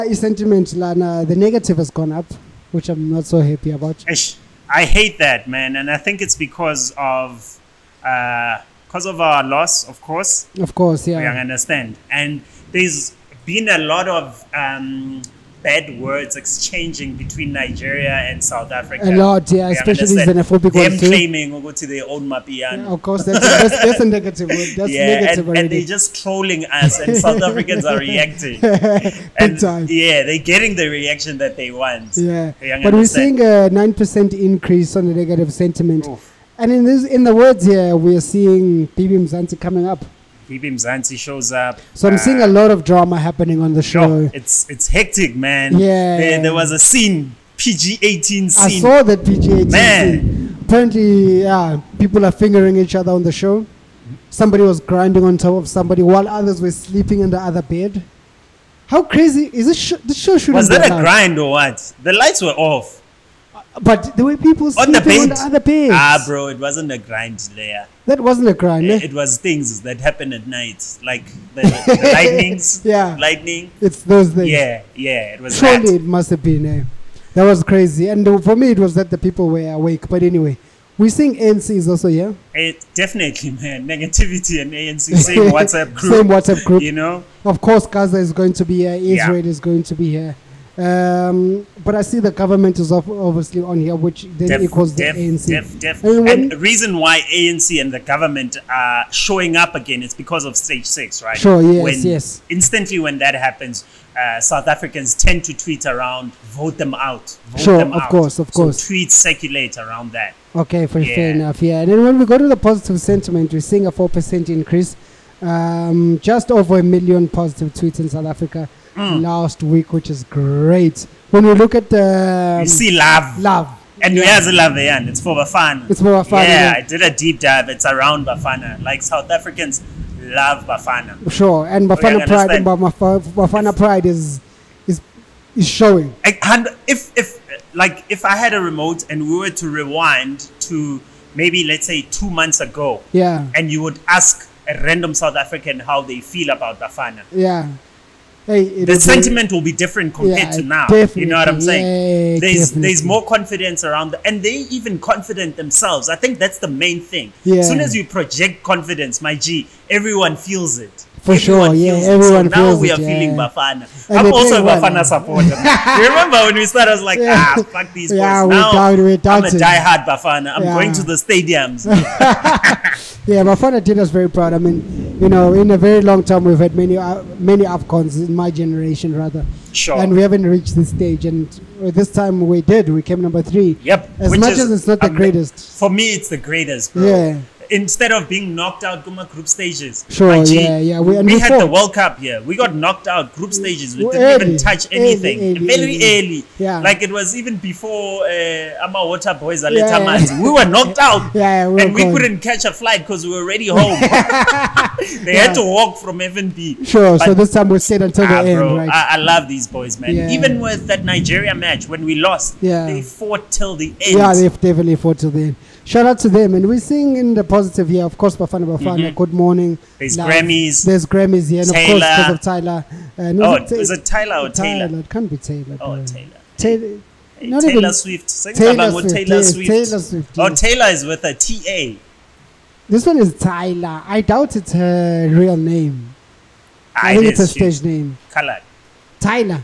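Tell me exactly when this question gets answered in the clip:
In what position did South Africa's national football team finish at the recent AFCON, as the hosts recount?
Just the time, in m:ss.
3:03.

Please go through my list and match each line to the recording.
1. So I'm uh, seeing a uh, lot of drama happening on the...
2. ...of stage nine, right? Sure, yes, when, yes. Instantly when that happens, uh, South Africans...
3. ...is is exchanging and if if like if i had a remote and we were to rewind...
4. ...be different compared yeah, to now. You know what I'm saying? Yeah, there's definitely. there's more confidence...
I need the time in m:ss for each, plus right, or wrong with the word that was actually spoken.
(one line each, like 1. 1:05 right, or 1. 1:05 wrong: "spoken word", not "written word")
1. 0:41 right
2. 1:40 wrong: "six", not "nine"
3. 2:14 wrong: "showing", not "exchanging"
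4. 2:29 right.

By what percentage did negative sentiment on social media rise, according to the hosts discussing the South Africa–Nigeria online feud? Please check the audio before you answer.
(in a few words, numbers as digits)
9%.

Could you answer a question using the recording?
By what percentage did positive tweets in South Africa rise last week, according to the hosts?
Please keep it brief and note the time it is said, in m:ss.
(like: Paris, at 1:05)
4%, at 1:53.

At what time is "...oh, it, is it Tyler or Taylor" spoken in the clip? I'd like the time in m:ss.
3:43.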